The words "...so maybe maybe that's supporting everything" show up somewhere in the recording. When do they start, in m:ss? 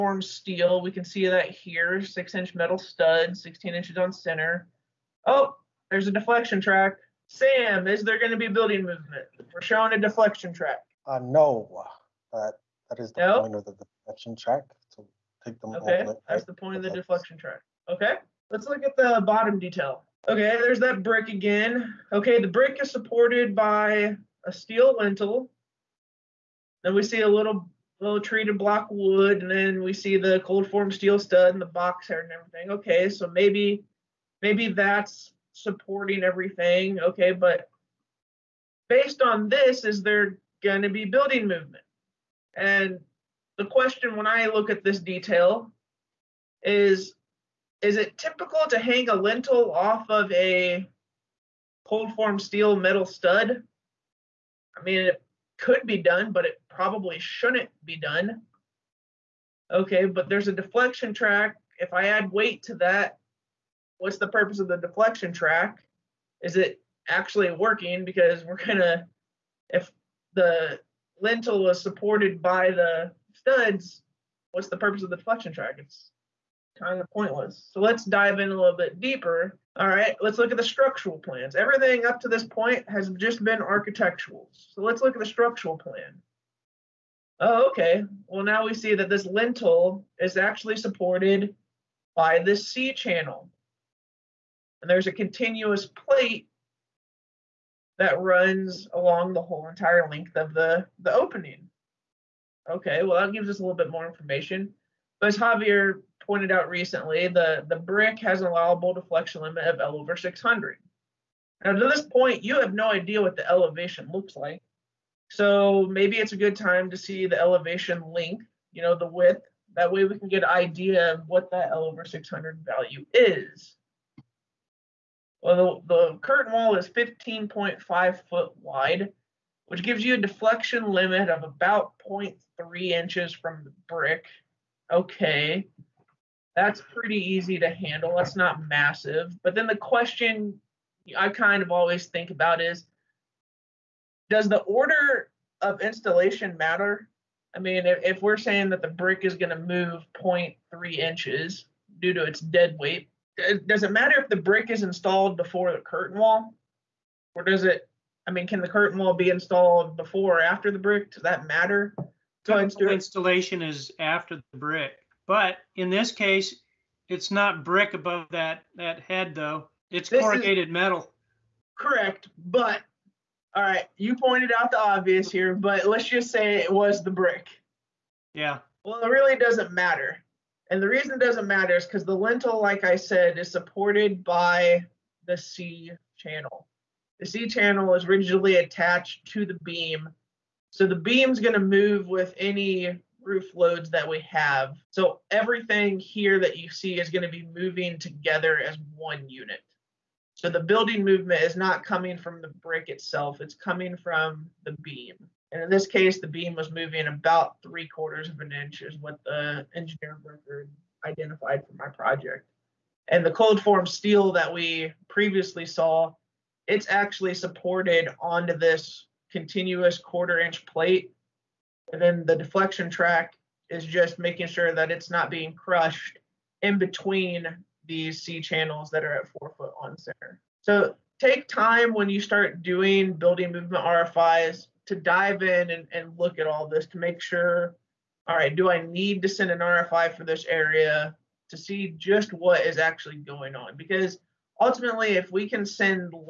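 0:33.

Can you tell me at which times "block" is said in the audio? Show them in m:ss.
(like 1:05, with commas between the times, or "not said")
0:28.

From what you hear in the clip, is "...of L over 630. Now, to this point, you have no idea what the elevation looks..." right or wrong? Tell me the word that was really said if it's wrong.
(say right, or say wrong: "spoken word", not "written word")
wrong: "600", not "630".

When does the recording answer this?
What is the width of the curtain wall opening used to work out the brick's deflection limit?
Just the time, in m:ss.
2:06.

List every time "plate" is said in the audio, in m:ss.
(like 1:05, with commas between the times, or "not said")
1:35, 3:40.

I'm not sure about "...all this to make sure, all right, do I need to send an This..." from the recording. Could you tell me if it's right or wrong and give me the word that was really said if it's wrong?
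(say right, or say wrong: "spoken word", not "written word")
wrong: "RFI", not "This".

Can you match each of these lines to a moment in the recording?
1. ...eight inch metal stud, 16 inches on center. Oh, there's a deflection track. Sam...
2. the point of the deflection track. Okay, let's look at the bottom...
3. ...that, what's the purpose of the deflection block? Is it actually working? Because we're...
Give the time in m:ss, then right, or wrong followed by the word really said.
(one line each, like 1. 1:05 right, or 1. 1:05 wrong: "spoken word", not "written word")
1. 0:02 wrong: "six", not "eight"
2. 0:16 right
3. 1:02 wrong: "track", not "block".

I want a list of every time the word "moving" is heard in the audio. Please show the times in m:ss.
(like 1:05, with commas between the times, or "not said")
3:17, 3:26.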